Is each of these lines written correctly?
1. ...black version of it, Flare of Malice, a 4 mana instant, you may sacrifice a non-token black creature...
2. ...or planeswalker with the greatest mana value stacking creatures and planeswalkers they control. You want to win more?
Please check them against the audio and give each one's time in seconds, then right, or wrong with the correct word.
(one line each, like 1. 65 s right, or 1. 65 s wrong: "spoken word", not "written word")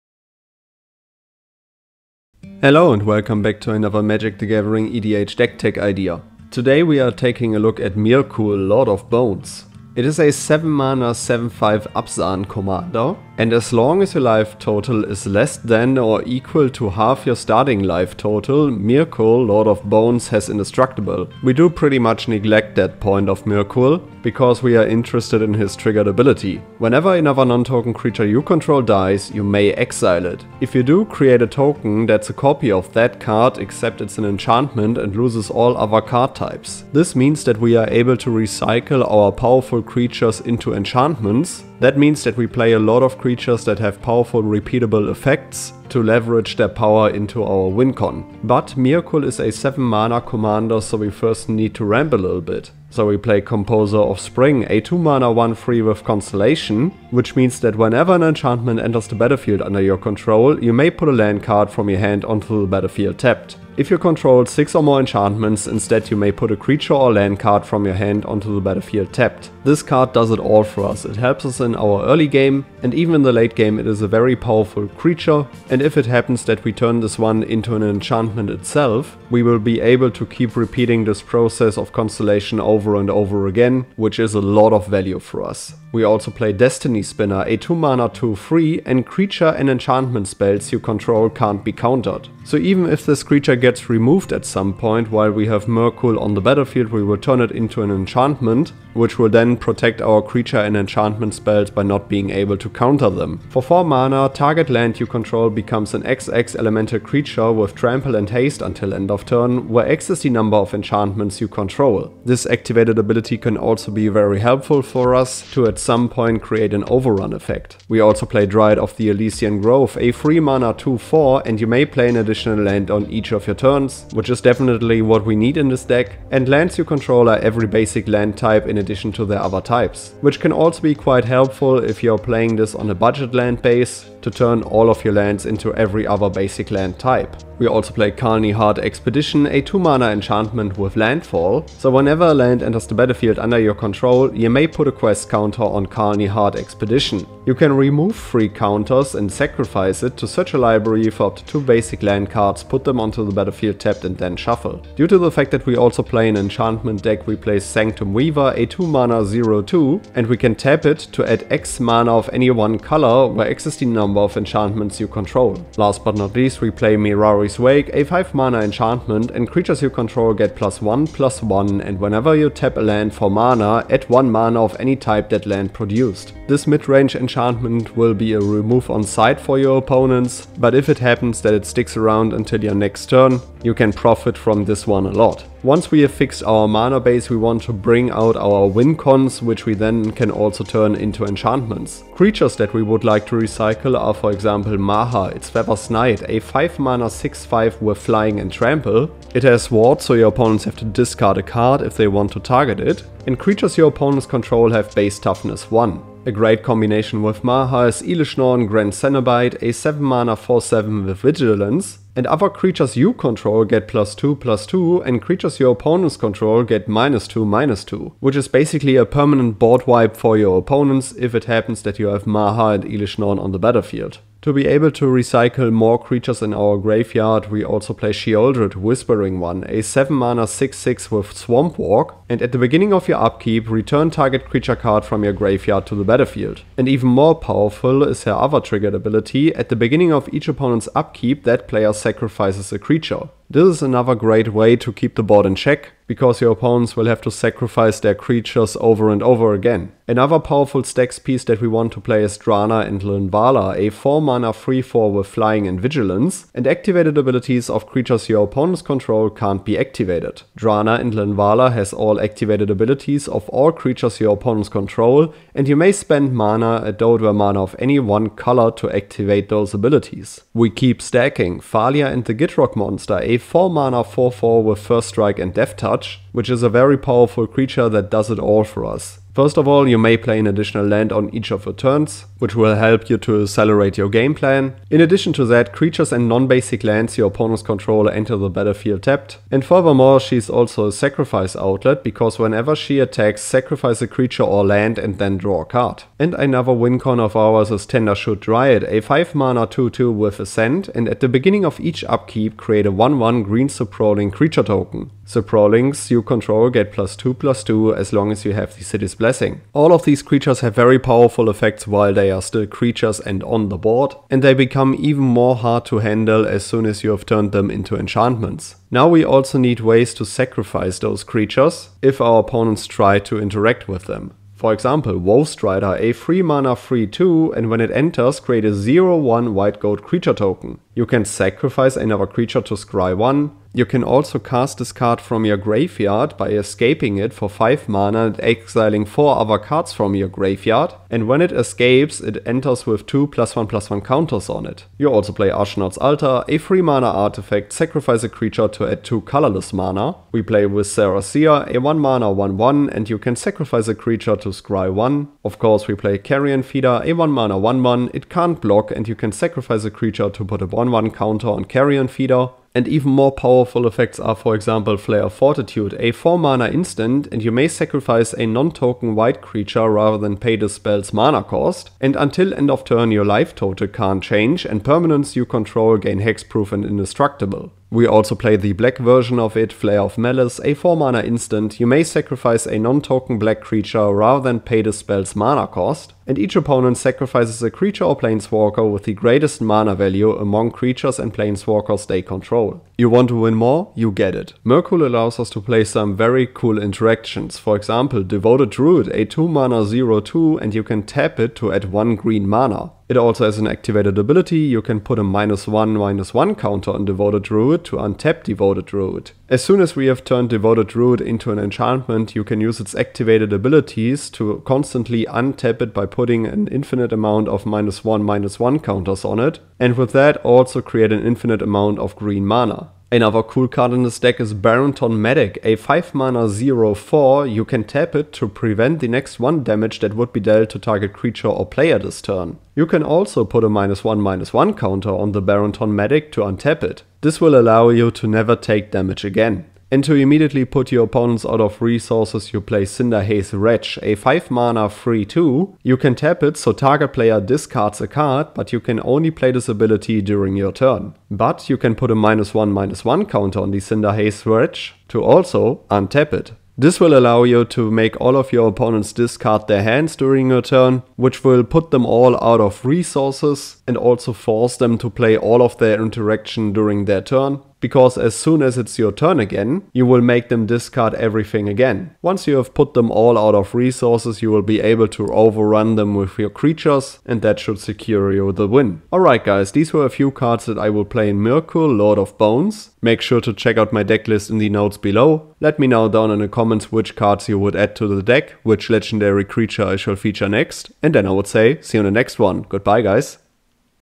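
1. 378 s right
2. 388 s wrong: "among", not "stacking".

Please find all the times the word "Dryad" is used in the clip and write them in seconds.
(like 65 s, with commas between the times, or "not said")
118 s, 298 s.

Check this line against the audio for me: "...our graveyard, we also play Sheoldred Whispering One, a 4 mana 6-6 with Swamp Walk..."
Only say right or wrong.
wrong.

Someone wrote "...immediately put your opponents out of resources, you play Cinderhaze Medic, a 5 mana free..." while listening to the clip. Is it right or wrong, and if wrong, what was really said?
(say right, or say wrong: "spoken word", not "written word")
wrong: "Wretch", not "Medic".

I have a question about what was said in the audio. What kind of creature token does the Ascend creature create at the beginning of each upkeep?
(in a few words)
Saproling.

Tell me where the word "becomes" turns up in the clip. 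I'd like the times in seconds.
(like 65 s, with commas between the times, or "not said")
105 s, 314 s.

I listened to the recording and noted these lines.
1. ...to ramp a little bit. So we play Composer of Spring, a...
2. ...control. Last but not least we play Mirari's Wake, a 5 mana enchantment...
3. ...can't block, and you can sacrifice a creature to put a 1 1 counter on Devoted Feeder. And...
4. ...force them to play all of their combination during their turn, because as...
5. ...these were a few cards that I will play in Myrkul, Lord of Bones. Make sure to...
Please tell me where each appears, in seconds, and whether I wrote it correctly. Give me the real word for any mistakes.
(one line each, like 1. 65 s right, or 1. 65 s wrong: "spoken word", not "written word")
1. 51 s right
2. 165 s right
3. 358 s wrong: "Carrion", not "Devoted"
4. 464 s wrong: "interaction", not "combination"
5. 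479 s right.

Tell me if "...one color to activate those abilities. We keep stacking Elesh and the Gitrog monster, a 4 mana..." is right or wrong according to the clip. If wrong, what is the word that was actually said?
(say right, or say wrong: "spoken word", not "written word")
wrong: "Thalia", not "Elesh".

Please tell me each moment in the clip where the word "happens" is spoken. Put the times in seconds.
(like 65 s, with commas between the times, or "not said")
76 s, 180 s, 221 s.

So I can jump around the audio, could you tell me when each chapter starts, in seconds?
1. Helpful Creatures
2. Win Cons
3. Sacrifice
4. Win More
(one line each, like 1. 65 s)
1. 48 s
2. 186 s
3. 319 s
4. 393 s.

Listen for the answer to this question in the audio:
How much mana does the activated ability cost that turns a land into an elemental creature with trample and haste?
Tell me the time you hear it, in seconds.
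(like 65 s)
103 s.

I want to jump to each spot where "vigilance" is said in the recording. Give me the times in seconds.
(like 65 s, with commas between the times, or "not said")
211 s, 255 s.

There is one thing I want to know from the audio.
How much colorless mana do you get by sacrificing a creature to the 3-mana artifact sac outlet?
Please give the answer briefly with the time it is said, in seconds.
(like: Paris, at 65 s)
2, at 348 s.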